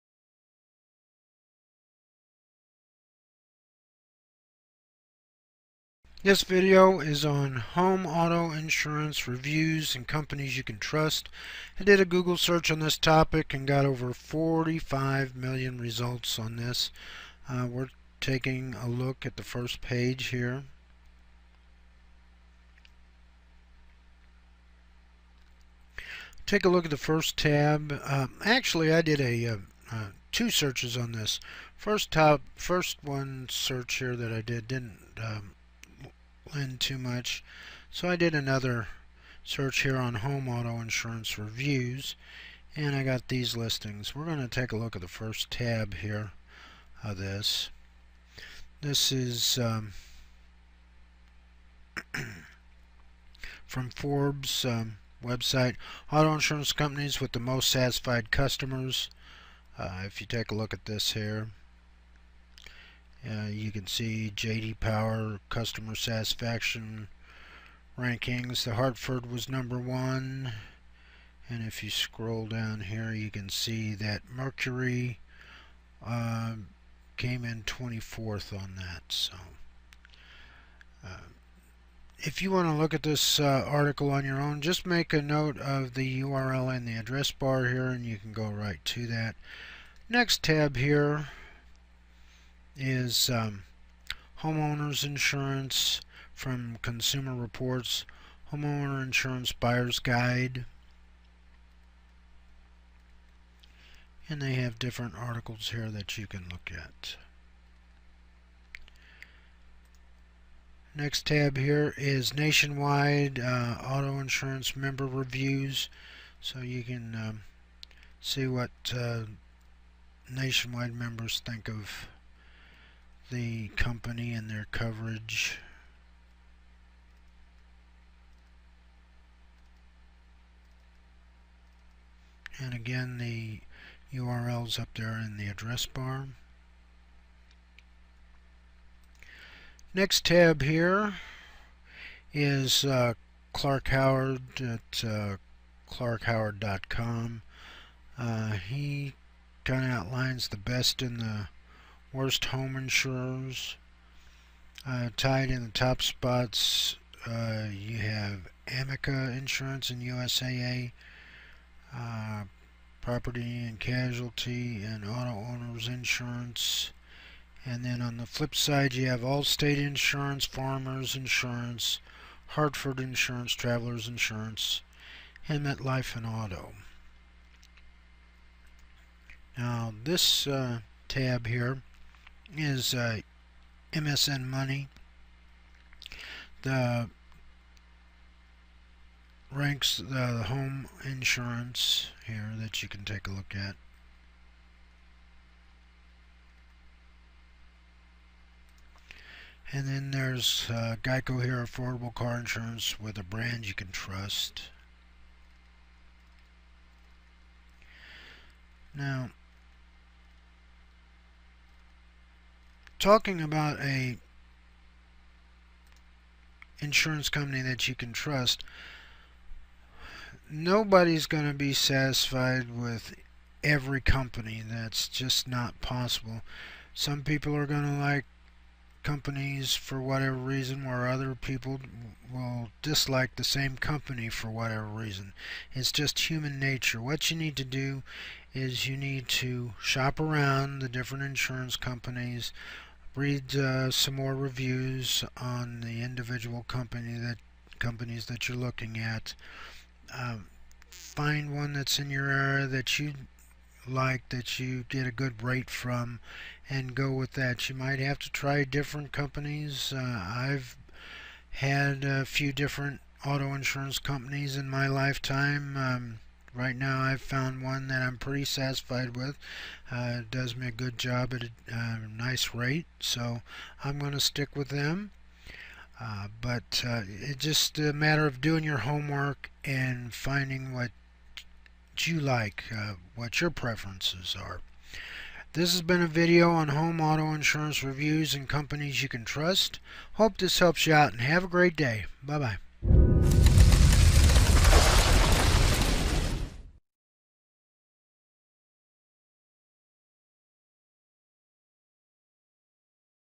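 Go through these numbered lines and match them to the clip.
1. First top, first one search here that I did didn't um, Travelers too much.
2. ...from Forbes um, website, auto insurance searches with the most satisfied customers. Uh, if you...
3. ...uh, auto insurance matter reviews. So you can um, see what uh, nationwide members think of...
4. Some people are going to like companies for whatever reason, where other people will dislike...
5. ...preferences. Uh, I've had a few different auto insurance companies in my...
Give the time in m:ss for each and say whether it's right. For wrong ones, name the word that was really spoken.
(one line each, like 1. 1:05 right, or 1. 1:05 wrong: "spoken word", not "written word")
1. 0:31 wrong: "Lend", not "Travelers"
2. 0:53 wrong: "companies", not "searches"
3. 1:53 wrong: "member", not "matter"
4. 3:46 right
5. 4:19 wrong: "companies", not "preferences".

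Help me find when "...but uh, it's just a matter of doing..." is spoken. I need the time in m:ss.
4:36.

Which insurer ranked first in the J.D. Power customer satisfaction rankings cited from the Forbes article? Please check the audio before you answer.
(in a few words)
The Hartford.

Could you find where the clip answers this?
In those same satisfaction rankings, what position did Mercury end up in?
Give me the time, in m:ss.
1:17.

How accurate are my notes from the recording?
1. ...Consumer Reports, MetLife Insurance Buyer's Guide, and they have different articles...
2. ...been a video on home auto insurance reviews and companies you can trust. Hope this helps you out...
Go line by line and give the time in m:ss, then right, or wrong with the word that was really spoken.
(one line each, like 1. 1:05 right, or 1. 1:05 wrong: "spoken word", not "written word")
1. 1:36 wrong: "Homeowner", not "MetLife"
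2. 4:45 right.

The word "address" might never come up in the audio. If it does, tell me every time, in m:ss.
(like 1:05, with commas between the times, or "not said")
1:26, 2:15.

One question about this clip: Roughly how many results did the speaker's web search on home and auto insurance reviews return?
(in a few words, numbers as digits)
45 million.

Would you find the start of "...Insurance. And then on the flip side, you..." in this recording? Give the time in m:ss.
2:45.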